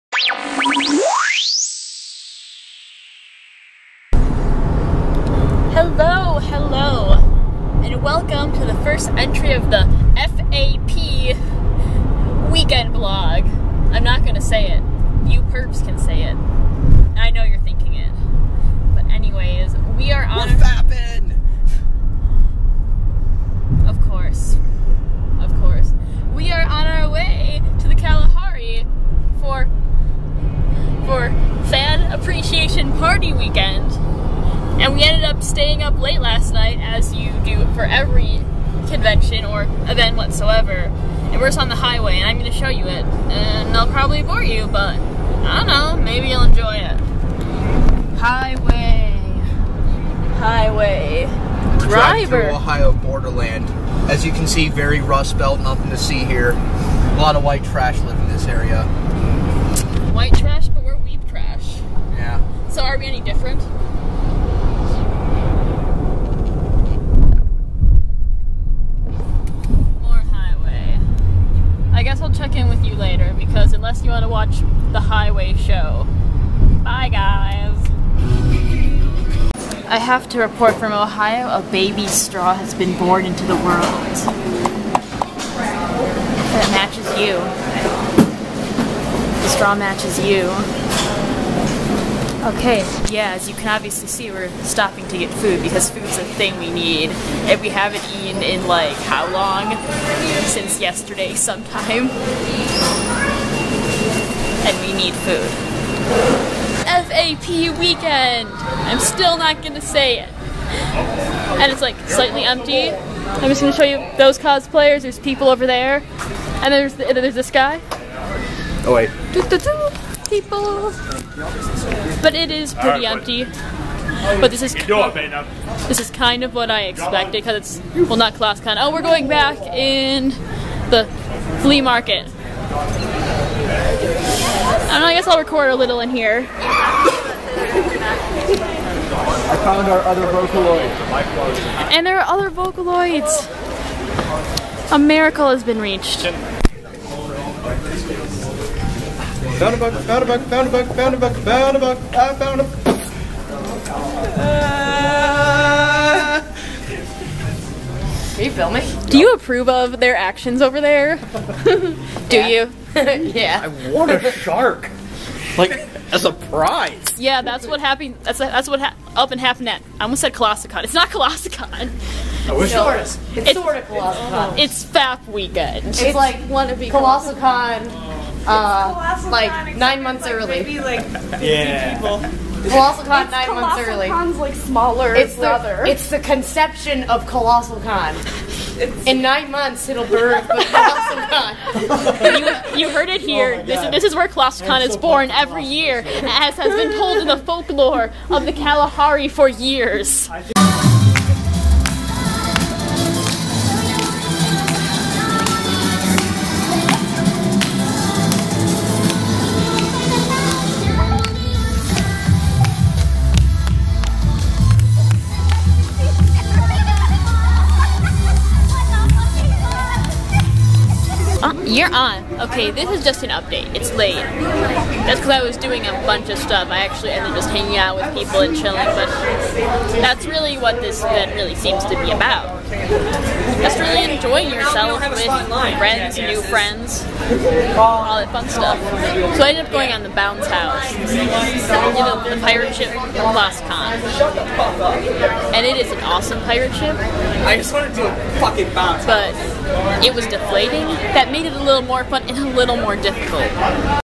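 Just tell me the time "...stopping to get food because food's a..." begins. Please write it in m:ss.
1:34.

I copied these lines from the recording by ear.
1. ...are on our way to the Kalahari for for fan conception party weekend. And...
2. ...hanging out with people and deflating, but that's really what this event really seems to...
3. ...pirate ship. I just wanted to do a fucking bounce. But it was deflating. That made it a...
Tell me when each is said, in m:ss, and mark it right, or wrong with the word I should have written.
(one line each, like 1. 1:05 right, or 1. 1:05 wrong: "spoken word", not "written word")
1. 0:26 wrong: "appreciation", not "conception"
2. 3:47 wrong: "chilling", not "deflating"
3. 4:06 right.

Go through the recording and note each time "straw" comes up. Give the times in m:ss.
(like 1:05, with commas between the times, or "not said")
1:22, 1:29.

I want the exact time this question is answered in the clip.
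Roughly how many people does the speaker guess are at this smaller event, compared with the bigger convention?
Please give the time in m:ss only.
3:01.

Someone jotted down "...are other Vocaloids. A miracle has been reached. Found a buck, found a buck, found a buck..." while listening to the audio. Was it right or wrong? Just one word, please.
right.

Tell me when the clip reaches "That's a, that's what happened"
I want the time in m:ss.
2:48.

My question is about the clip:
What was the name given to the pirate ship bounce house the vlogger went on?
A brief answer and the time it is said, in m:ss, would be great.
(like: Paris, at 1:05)
Lost Con, at 4:03.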